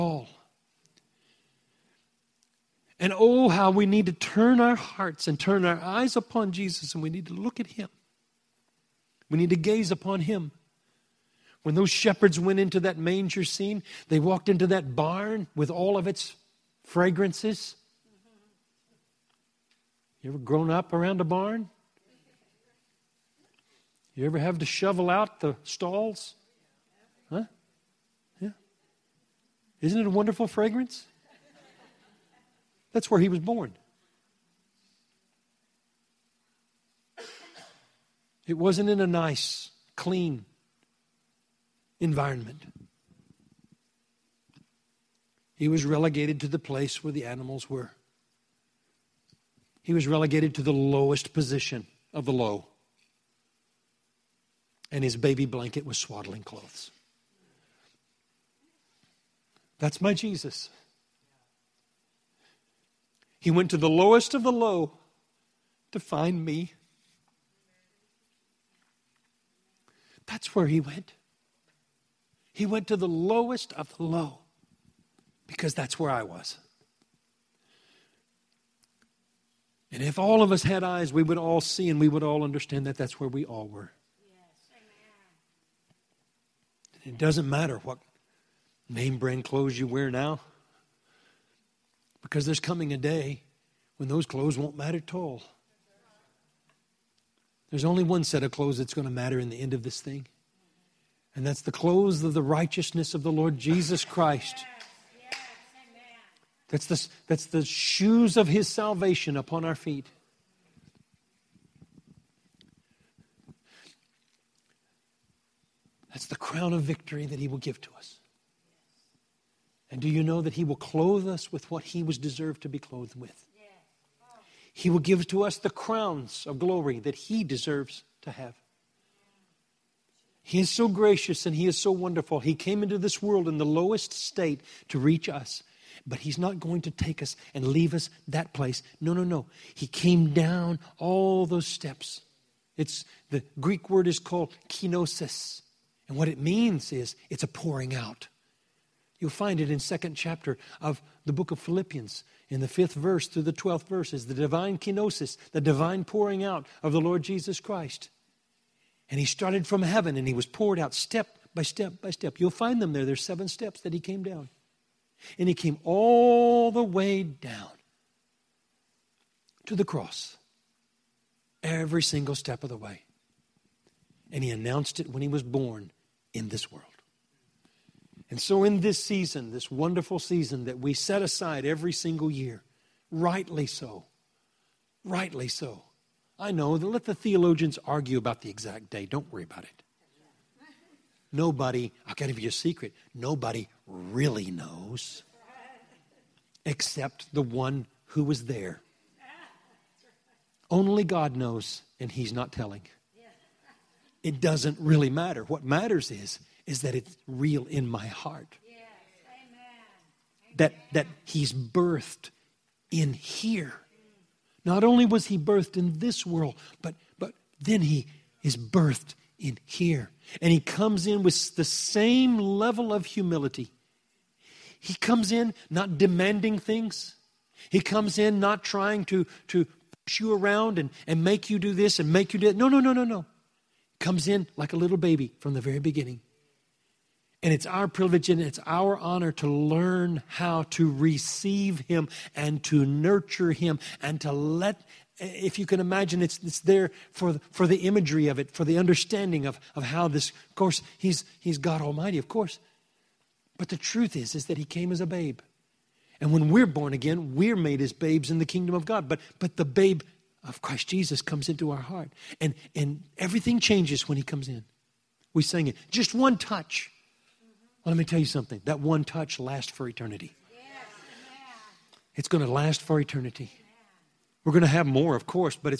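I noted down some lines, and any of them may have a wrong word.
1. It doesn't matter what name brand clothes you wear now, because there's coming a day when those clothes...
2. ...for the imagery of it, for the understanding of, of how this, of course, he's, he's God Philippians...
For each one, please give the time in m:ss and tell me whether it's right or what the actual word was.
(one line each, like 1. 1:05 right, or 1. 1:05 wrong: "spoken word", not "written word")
1. 1:27 right
2. 4:07 wrong: "Almighty", not "Philippians".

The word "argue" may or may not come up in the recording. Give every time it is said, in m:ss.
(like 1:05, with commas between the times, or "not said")
3:07.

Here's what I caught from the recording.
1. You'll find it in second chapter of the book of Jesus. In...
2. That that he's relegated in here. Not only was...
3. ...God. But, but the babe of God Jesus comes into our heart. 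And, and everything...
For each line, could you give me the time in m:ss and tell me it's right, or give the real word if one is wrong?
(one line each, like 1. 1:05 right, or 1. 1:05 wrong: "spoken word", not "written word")
1. 2:29 wrong: "Philippians", not "Jesus"
2. 3:30 wrong: "birthed", not "relegated"
3. 4:18 wrong: "Christ", not "God".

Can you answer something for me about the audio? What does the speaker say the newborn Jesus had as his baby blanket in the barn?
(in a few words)
swaddling clothes.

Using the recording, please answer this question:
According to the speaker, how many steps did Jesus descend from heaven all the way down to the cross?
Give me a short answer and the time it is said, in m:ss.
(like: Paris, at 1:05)
7, at 2:43.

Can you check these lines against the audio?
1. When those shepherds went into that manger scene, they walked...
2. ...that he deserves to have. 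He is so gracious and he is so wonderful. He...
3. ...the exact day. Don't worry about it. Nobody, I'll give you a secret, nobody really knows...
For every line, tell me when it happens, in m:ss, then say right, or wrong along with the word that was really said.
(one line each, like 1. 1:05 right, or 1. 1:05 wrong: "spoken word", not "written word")
1. 0:11 right
2. 2:06 right
3. 3:08 right.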